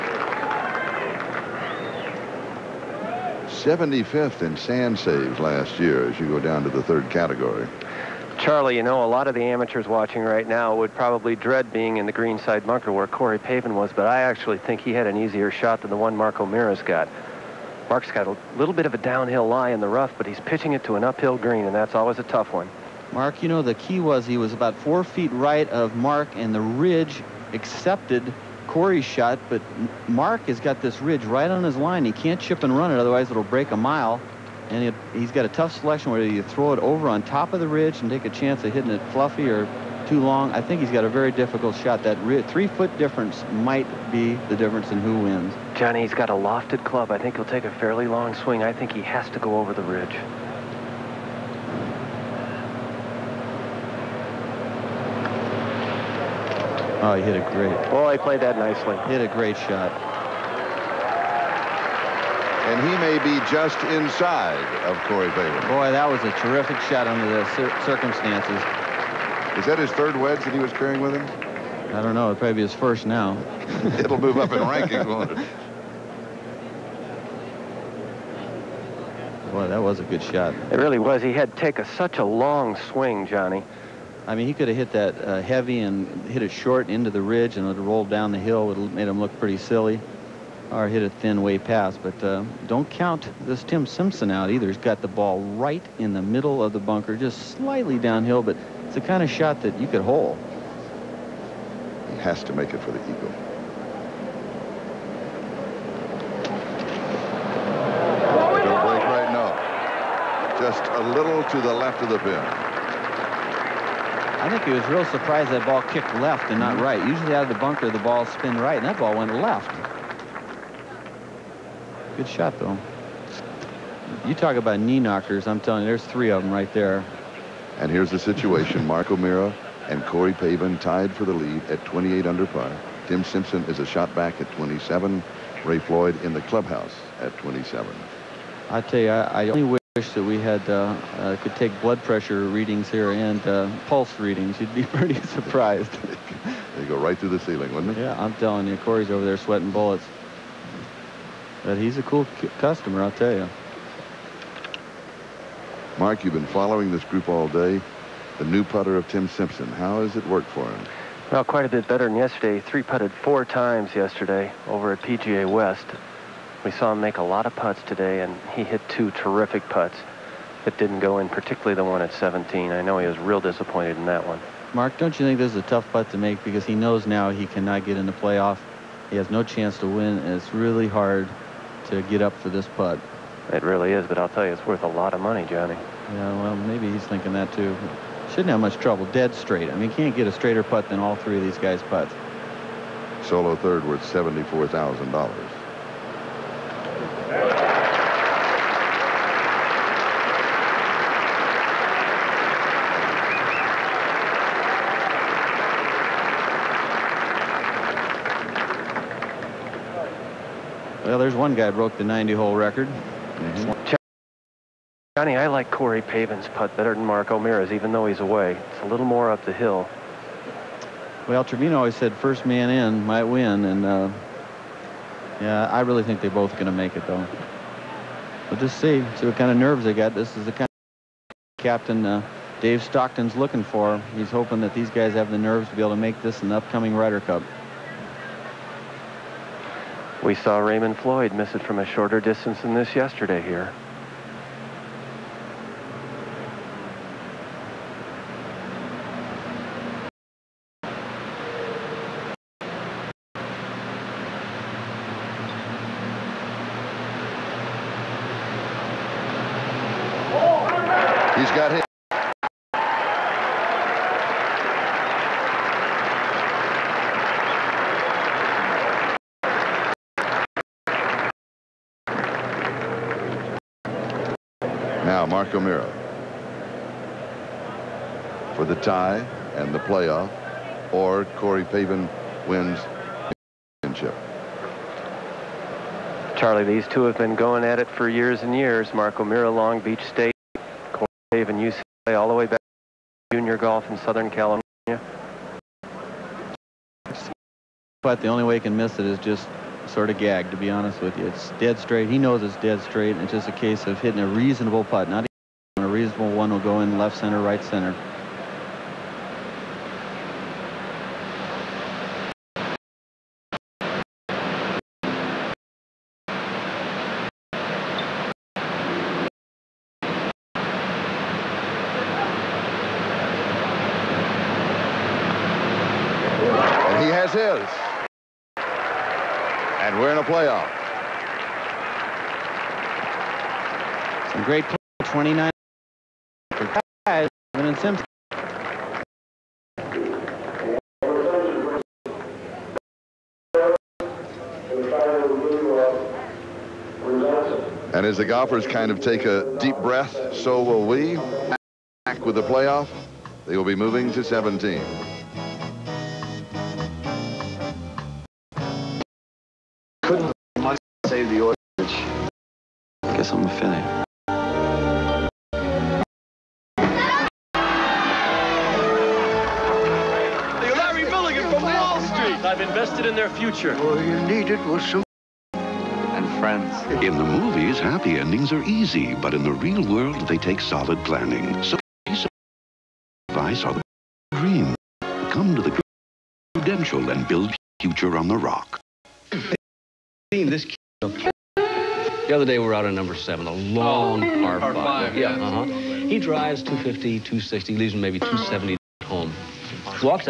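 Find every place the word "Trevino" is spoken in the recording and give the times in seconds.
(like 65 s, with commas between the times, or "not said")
221 s.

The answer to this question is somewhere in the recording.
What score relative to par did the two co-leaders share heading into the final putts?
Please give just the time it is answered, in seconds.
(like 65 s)
131 s.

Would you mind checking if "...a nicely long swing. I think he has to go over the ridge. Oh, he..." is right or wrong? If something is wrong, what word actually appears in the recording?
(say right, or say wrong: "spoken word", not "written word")
wrong: "fairly", not "nicely".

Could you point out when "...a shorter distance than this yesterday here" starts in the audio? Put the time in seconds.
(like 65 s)
241 s.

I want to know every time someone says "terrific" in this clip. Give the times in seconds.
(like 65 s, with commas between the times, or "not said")
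66 s, 169 s.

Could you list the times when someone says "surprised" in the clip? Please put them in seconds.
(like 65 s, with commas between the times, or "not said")
115 s, 145 s.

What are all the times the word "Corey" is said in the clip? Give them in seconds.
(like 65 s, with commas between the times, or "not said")
13 s, 28 s, 65 s, 130 s, 148 s, 215 s, 281 s, 290 s.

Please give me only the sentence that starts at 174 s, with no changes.
Mark, don't you think this is a tough putt to make because he knows now he cannot get in the playoff.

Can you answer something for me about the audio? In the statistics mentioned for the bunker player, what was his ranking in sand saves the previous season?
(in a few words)
75th.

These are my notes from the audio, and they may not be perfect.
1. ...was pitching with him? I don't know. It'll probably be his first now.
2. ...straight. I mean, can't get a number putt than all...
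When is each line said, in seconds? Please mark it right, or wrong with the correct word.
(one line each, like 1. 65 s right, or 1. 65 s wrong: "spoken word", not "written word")
1. 70 s wrong: "carrying", not "pitching"
2. 189 s wrong: "straighter", not "number".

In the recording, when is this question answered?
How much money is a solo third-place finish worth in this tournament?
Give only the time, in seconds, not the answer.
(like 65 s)
194 s.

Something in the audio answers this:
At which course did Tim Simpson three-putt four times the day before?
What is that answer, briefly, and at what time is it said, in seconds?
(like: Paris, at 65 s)
PGA West, at 164 s.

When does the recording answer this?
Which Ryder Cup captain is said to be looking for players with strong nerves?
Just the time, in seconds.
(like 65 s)
232 s.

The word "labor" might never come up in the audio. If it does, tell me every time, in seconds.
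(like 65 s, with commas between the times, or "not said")
not said.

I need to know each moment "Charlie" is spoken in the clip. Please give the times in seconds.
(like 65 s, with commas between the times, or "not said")
8 s, 286 s.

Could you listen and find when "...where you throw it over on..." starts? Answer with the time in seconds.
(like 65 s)
36 s.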